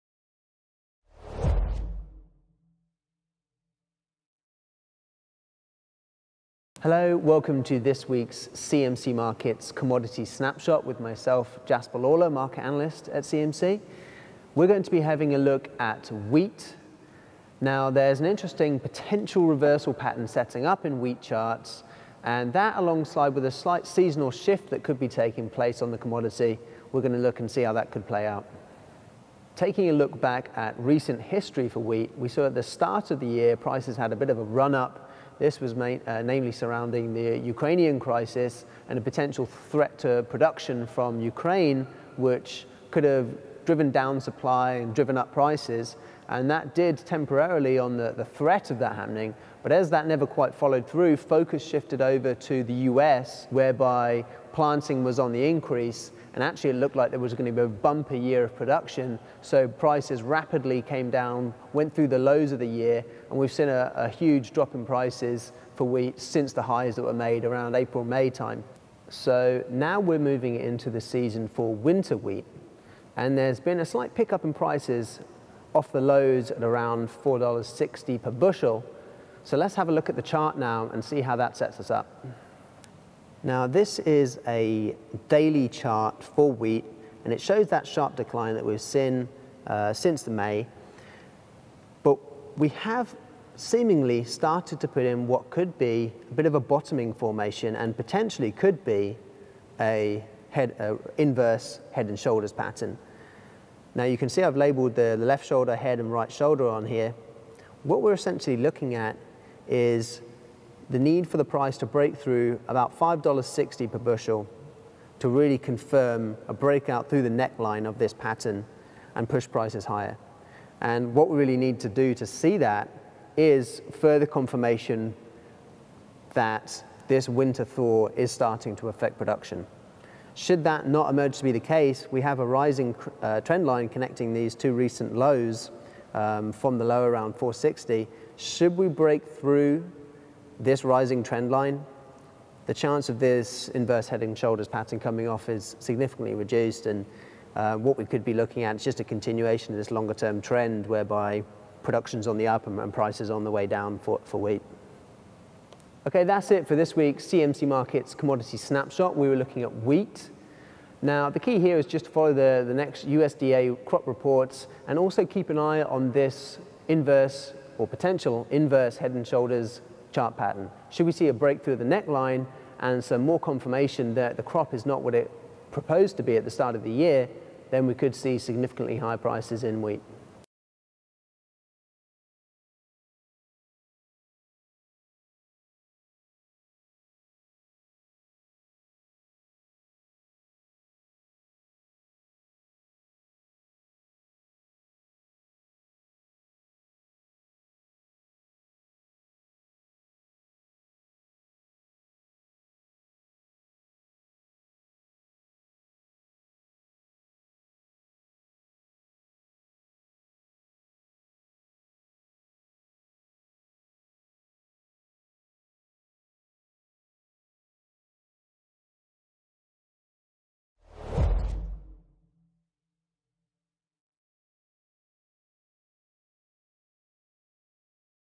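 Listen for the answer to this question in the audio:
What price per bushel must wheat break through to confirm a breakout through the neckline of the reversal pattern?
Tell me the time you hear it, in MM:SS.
01:52.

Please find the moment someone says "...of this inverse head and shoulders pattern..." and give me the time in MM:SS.
02:23.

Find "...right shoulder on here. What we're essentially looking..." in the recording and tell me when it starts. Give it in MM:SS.
01:46.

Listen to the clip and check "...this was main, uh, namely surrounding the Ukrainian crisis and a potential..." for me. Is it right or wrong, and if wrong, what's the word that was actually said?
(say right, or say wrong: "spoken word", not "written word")
right.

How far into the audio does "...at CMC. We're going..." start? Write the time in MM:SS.
00:13.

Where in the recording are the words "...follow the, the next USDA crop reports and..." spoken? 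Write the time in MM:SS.
02:42.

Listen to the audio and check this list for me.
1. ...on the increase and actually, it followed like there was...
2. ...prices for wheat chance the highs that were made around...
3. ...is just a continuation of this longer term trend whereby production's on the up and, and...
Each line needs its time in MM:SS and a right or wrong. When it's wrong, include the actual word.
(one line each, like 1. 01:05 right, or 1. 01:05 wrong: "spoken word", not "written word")
1. 00:55 wrong: "looked", not "followed"
2. 01:04 wrong: "since", not "chance"
3. 02:28 right.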